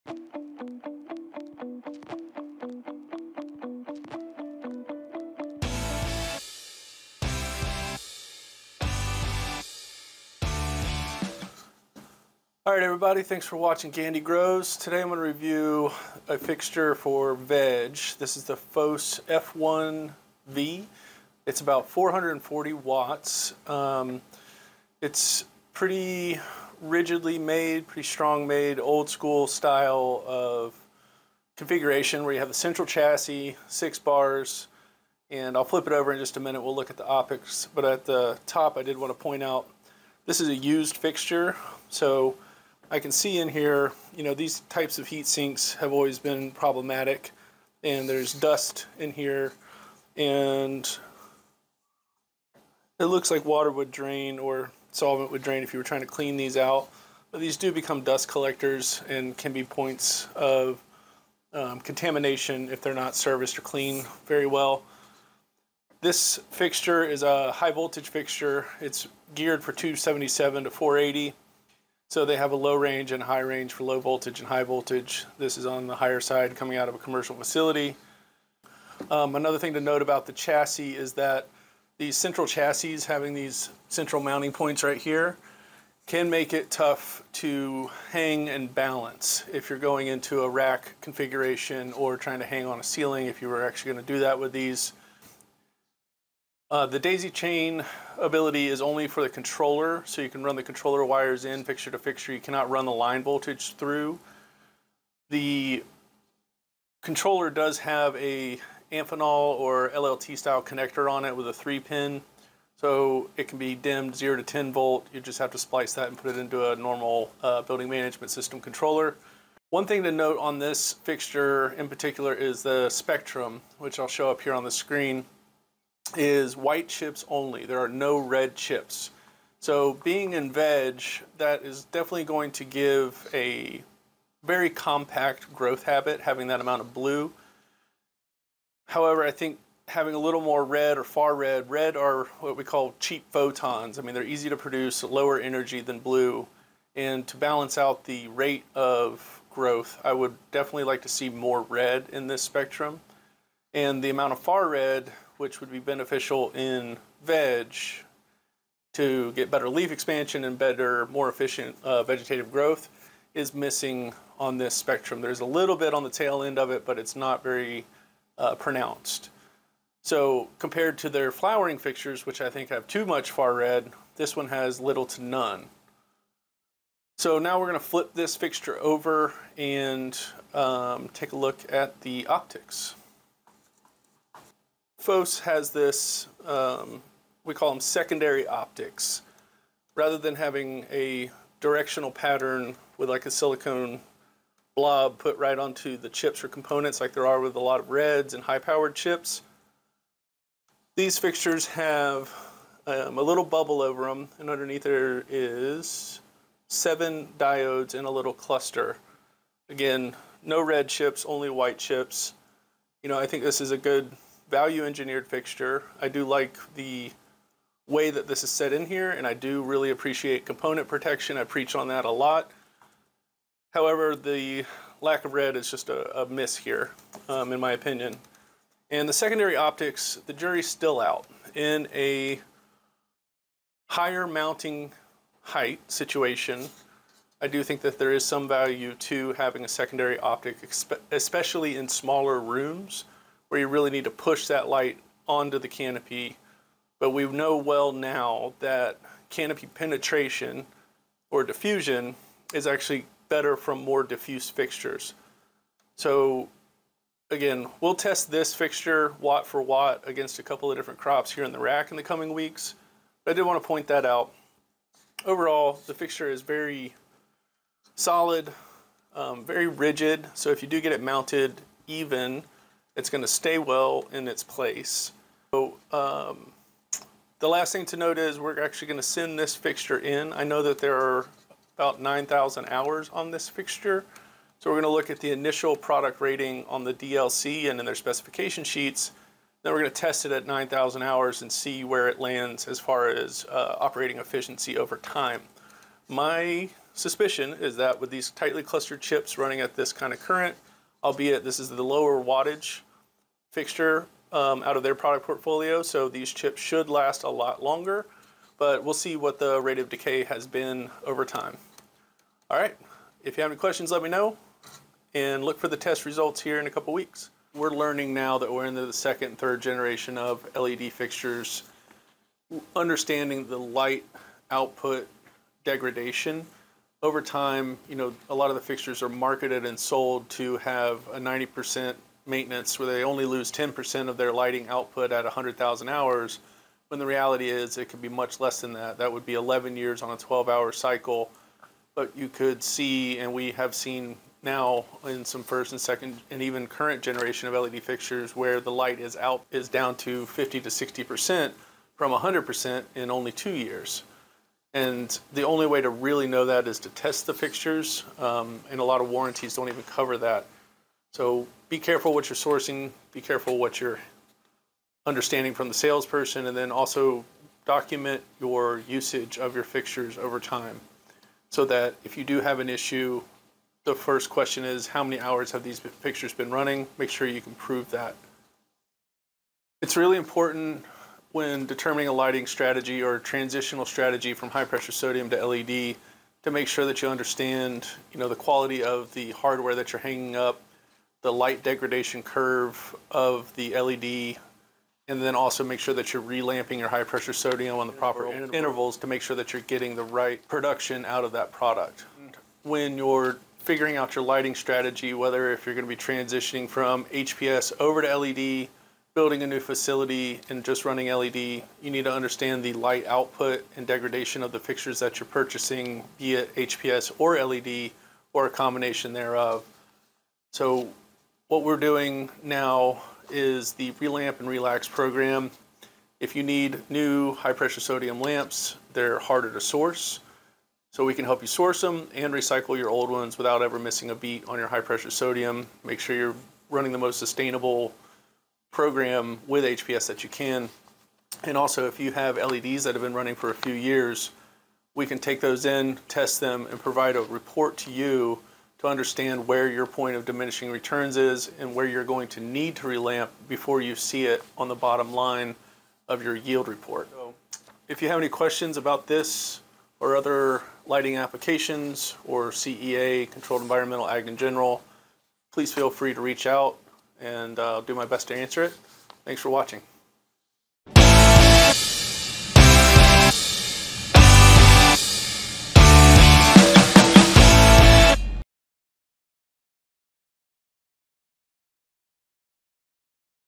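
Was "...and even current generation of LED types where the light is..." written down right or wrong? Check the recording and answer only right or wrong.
wrong.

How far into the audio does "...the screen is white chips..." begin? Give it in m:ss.
2:04.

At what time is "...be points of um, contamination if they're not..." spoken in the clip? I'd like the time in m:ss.
0:59.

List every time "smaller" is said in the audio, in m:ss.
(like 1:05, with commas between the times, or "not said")
4:01.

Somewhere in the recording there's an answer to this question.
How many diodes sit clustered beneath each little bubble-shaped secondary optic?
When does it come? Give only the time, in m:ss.
3:26.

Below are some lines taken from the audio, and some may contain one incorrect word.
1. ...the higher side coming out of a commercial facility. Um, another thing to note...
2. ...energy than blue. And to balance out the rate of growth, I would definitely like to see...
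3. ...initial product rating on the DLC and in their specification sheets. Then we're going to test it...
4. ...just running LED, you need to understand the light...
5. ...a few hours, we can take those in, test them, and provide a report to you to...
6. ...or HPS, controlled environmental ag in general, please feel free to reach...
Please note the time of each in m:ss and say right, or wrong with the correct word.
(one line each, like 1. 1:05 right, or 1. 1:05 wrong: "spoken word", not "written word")
1. 1:15 right
2. 2:25 right
3. 4:45 right
4. 6:50 right
5. 7:23 wrong: "years", not "hours"
6. 7:42 wrong: "CEA", not "HPS".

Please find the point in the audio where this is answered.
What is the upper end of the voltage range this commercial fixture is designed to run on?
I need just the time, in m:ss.
1:10.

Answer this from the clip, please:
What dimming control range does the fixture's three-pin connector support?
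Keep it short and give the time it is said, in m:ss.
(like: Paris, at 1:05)
0 to 10 volt, at 1:54.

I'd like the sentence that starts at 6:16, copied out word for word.
Make sure you can prove that.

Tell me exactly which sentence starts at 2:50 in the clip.
So compared to their flowering fixtures, which I think have too much far red, this one has little to none.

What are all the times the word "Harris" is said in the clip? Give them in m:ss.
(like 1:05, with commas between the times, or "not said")
not said.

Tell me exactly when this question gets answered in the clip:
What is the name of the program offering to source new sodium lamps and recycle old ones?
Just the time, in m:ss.
7:03.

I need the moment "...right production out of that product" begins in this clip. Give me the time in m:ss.
6:40.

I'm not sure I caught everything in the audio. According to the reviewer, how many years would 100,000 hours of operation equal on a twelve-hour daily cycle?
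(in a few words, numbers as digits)
11 years.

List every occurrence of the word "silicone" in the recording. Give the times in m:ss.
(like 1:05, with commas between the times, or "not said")
3:13.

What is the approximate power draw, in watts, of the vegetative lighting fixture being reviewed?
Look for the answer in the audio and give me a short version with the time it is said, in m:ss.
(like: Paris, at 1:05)
440 watts, at 0:21.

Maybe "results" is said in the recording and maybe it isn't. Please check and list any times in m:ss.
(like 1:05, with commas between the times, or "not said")
5:16.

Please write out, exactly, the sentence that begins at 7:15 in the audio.
Make sure you're running the most sustainable program with HPS that you can.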